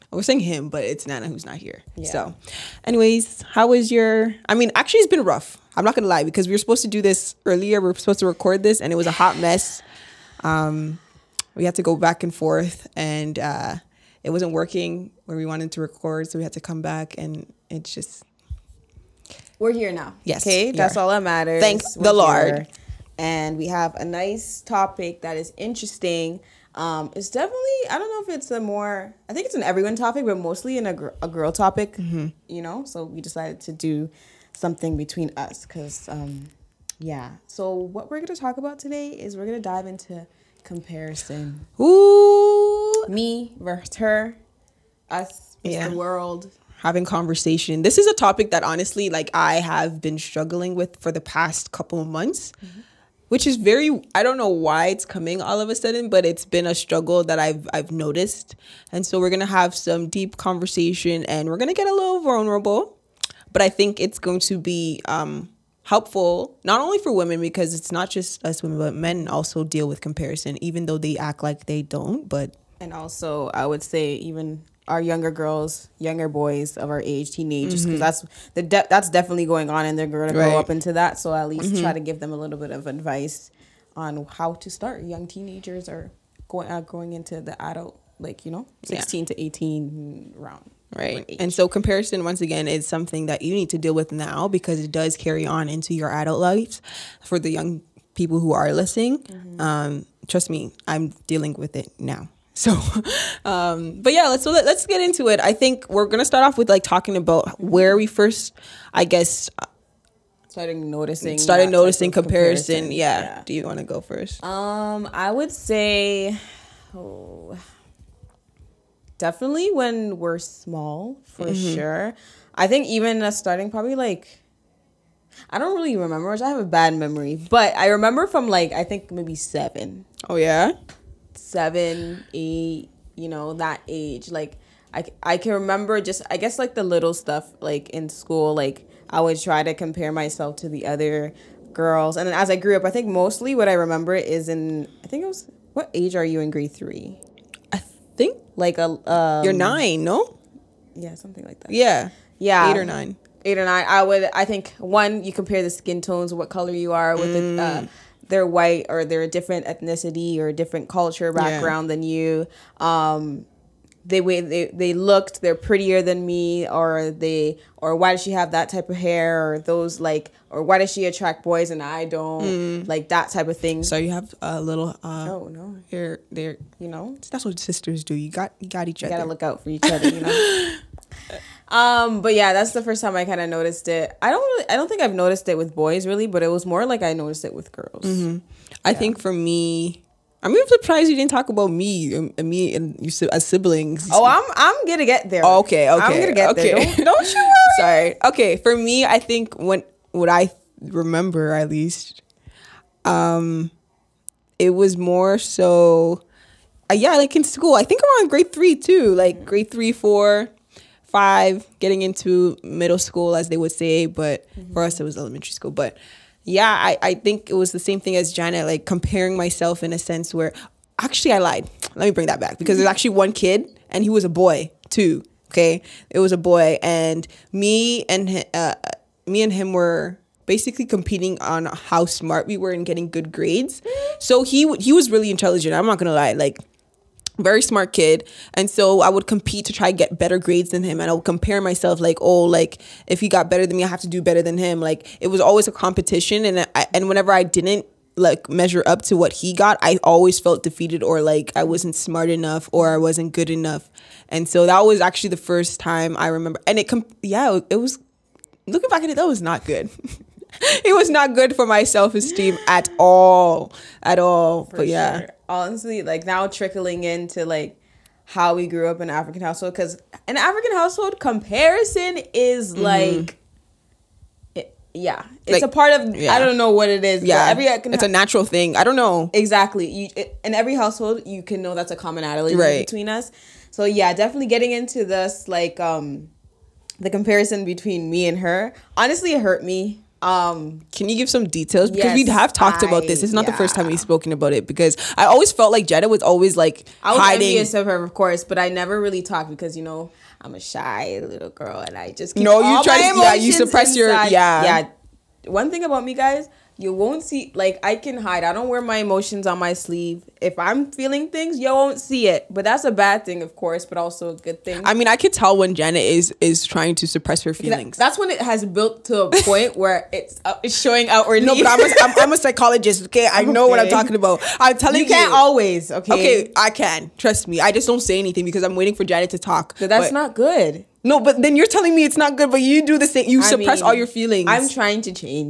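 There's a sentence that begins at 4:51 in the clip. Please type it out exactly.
Because yes, we have talked I, about this.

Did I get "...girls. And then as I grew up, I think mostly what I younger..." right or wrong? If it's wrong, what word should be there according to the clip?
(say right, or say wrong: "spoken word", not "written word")
wrong: "remember", not "younger".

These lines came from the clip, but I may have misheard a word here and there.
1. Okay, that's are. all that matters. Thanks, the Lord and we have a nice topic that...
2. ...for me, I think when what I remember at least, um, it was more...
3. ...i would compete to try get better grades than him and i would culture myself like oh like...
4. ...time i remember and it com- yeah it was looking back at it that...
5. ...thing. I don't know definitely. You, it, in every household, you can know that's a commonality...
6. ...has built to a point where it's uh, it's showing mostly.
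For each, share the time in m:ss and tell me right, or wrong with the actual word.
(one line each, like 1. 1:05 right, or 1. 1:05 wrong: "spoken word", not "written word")
1. 0:20 right
2. 3:18 right
3. 3:59 wrong: "compare", not "culture"
4. 4:15 right
5. 4:38 wrong: "exactly", not "definitely"
6. 5:18 wrong: "outwardly", not "mostly".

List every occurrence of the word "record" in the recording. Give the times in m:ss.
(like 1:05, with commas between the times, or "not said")
0:08, 0:15.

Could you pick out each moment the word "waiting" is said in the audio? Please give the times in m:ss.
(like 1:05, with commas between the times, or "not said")
5:28.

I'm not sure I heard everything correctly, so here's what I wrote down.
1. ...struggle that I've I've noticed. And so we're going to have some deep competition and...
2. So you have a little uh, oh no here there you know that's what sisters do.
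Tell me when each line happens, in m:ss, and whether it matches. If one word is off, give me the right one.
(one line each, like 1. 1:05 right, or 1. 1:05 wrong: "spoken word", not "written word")
1. 0:56 wrong: "conversation", not "competition"
2. 2:53 right.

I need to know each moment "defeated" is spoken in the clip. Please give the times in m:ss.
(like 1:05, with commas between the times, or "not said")
4:10.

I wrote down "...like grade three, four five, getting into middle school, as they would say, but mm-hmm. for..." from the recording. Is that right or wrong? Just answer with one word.
right.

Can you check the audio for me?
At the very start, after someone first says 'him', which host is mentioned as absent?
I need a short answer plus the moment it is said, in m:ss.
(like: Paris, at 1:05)
Nana, at 0:01.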